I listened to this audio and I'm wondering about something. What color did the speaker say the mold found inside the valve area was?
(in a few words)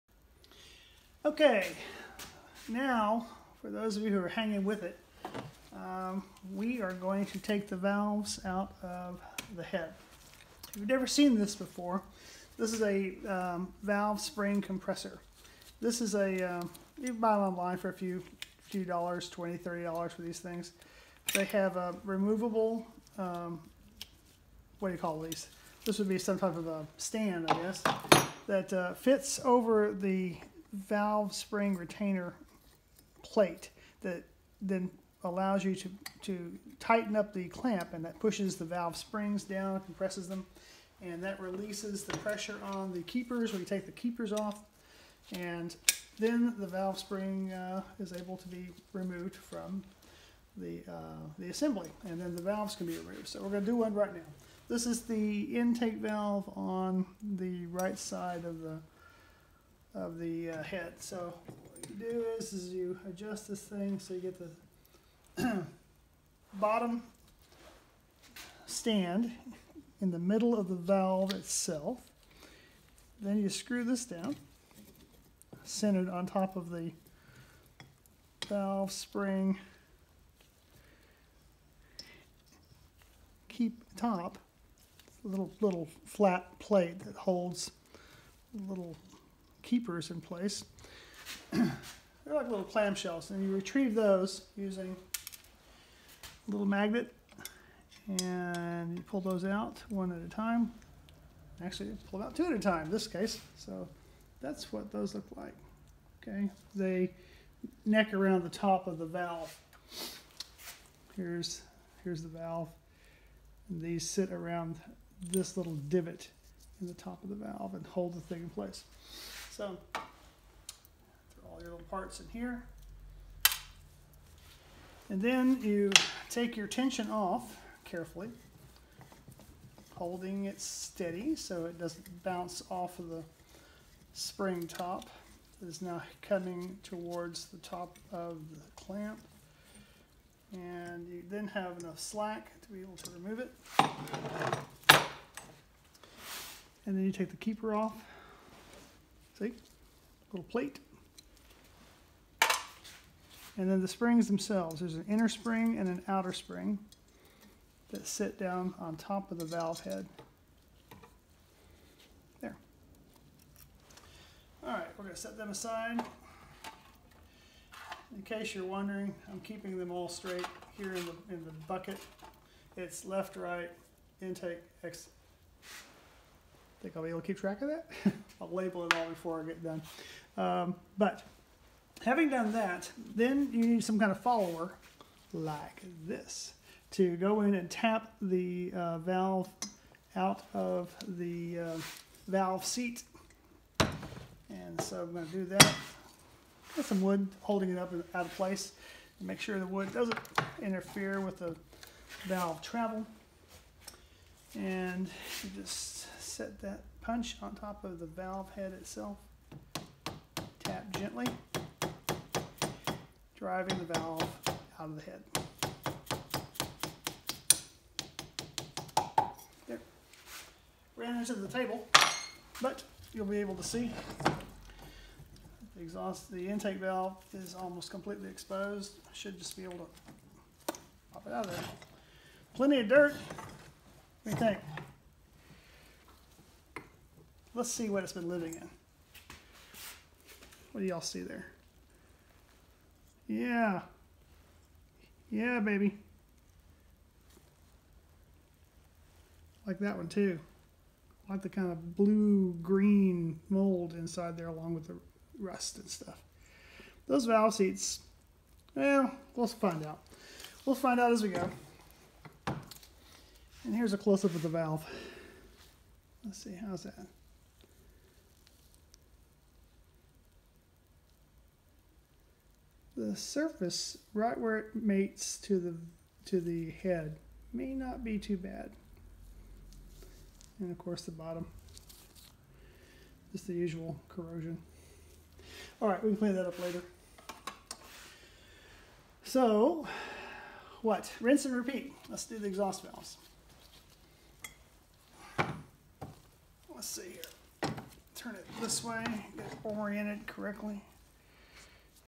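blue-green.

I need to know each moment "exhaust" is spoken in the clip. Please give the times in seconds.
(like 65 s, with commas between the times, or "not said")
225 s, 292 s.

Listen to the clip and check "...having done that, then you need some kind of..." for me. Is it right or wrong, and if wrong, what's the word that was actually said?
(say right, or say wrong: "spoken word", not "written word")
right.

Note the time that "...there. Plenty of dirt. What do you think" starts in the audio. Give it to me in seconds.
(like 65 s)
231 s.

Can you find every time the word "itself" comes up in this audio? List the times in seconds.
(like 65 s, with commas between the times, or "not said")
71 s, 208 s.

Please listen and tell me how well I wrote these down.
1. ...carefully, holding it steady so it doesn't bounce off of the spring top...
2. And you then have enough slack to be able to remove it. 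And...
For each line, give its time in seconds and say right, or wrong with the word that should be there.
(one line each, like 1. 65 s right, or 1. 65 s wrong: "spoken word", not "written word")
1. 127 s right
2. 140 s right.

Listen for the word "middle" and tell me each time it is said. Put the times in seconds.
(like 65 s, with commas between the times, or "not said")
70 s.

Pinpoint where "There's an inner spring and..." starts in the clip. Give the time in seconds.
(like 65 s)
154 s.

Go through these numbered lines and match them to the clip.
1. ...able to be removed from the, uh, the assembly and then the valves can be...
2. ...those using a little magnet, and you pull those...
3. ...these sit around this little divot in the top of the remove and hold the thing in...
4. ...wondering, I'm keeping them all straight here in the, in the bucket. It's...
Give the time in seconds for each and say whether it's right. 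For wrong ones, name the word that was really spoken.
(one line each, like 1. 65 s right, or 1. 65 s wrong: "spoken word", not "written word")
1. 48 s right
2. 93 s right
3. 113 s wrong: "valve", not "remove"
4. 168 s right.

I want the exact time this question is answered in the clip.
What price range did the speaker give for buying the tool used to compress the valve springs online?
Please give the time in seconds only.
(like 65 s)
19 s.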